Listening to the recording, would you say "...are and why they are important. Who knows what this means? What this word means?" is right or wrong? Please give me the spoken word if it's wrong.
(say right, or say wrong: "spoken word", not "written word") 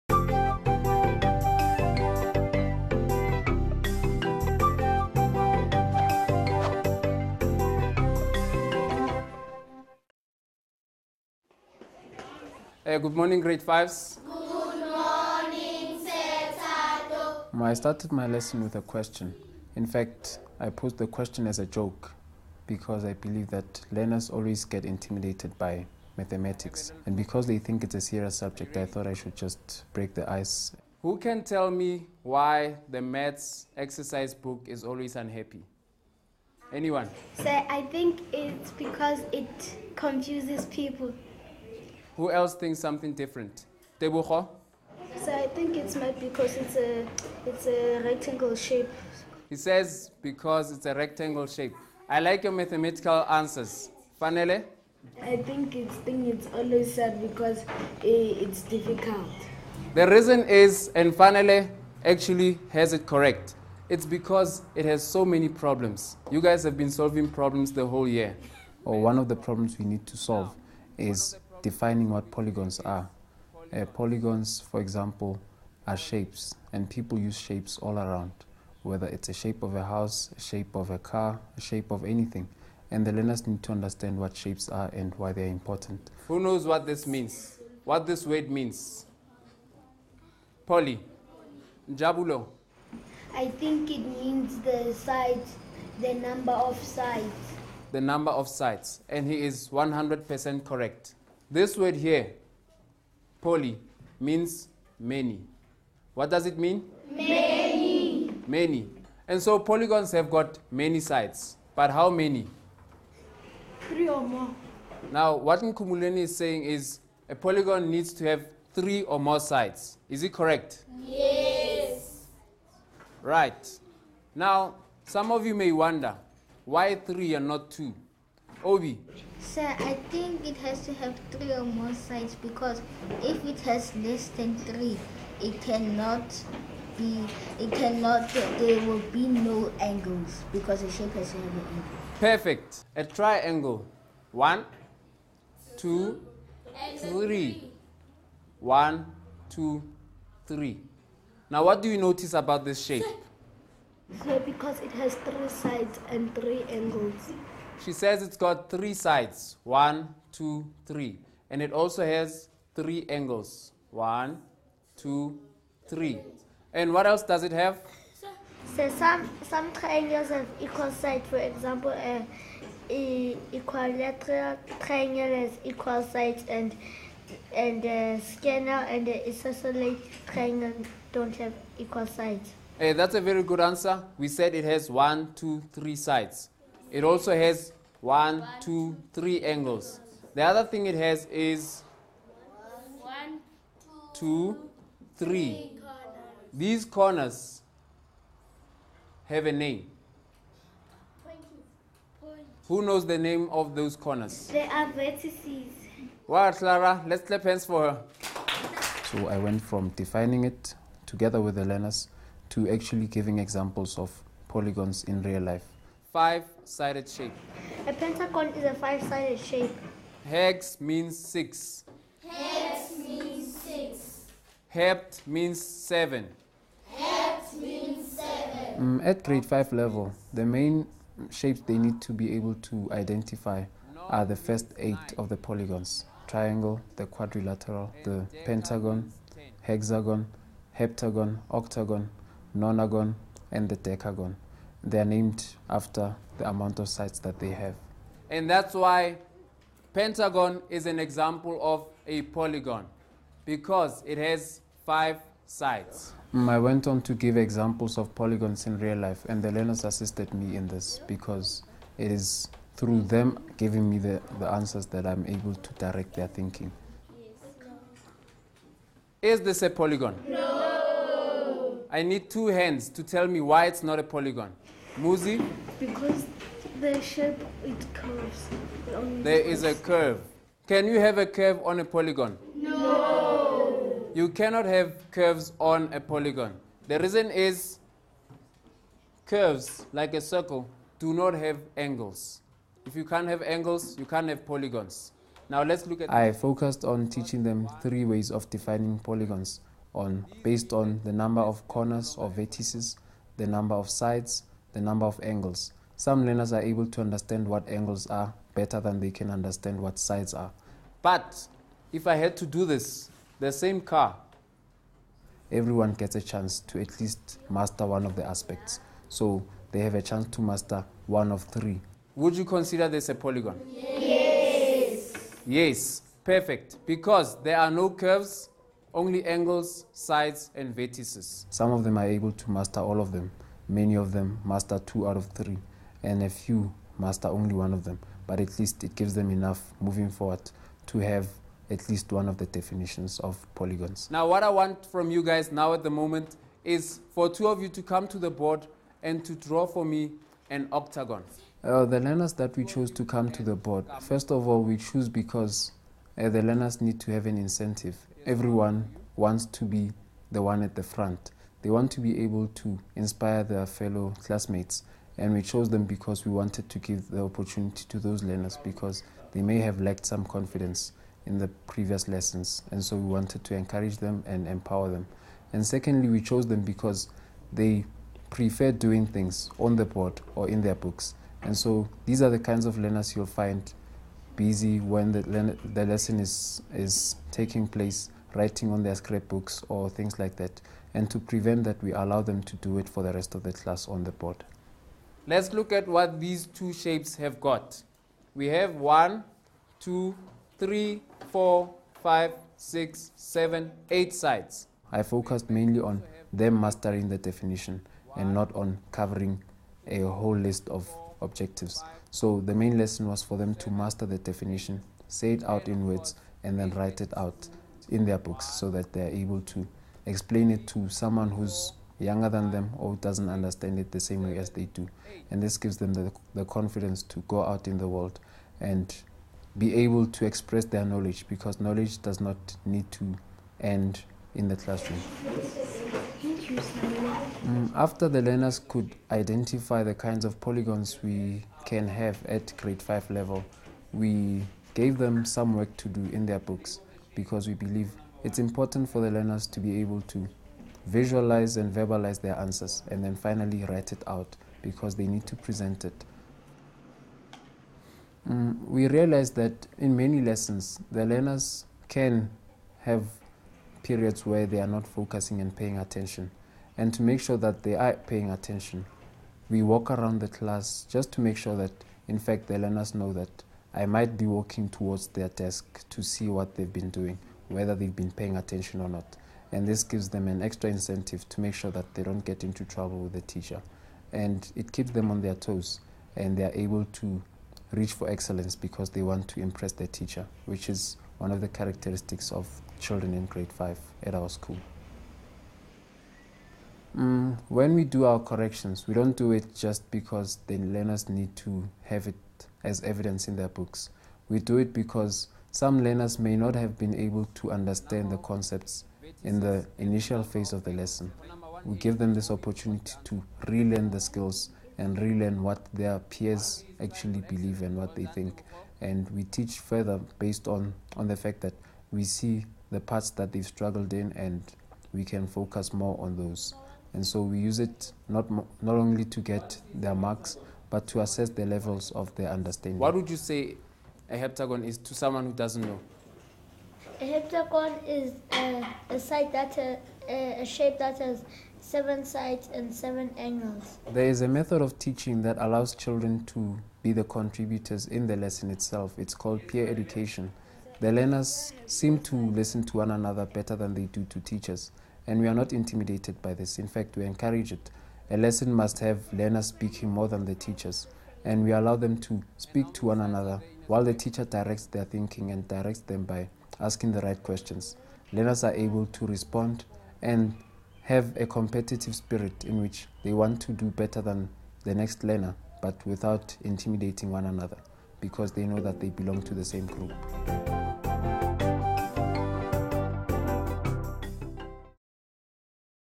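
right.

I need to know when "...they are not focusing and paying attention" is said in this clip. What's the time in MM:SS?
07:44.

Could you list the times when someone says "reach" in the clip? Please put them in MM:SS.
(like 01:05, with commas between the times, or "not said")
08:07.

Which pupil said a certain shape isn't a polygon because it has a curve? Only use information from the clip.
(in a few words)
Muzi.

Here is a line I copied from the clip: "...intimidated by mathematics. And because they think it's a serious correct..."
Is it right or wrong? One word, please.
wrong.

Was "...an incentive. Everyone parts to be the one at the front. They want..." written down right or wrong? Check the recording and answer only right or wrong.
wrong.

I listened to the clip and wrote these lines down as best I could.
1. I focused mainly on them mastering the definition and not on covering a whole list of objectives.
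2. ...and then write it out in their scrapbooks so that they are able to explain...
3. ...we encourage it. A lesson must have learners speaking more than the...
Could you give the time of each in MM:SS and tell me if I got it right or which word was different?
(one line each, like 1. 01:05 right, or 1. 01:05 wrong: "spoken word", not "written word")
1. 06:44 right
2. 06:56 wrong: "books", not "scrapbooks"
3. 09:16 right.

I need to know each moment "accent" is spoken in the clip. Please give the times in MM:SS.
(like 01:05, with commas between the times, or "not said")
not said.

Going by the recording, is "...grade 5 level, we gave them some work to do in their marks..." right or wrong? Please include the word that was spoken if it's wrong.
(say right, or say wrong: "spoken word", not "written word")
wrong: "books", not "marks".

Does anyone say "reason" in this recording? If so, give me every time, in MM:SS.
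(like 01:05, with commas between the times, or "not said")
01:00, 04:46.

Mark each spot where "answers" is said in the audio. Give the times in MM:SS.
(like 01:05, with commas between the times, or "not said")
00:53, 03:03, 04:24, 07:32.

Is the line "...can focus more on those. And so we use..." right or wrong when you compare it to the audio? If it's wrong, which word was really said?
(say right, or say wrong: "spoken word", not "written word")
right.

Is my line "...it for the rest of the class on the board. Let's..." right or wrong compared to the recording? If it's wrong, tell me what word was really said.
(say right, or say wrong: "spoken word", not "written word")
right.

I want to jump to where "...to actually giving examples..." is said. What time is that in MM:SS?
03:32.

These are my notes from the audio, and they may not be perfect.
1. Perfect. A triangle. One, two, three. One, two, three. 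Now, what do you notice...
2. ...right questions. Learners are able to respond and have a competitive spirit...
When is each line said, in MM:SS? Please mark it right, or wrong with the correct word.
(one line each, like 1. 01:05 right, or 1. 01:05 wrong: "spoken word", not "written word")
1. 02:22 right
2. 09:27 right.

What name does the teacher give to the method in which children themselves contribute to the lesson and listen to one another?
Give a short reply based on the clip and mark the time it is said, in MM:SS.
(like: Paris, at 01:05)
peer education, at 09:09.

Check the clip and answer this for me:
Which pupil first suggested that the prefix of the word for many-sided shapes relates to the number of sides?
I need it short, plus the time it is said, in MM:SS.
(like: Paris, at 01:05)
Jabulo, at 01:31.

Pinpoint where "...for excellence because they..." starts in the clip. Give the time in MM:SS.
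08:07.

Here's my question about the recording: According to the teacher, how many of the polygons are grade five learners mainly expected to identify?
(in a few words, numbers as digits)
8.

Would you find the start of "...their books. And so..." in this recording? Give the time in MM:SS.
06:20.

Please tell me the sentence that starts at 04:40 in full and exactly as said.
Can you have a curve on a polygon?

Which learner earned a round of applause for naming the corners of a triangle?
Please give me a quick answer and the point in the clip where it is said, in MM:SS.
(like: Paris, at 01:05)
Clara, at 03:26.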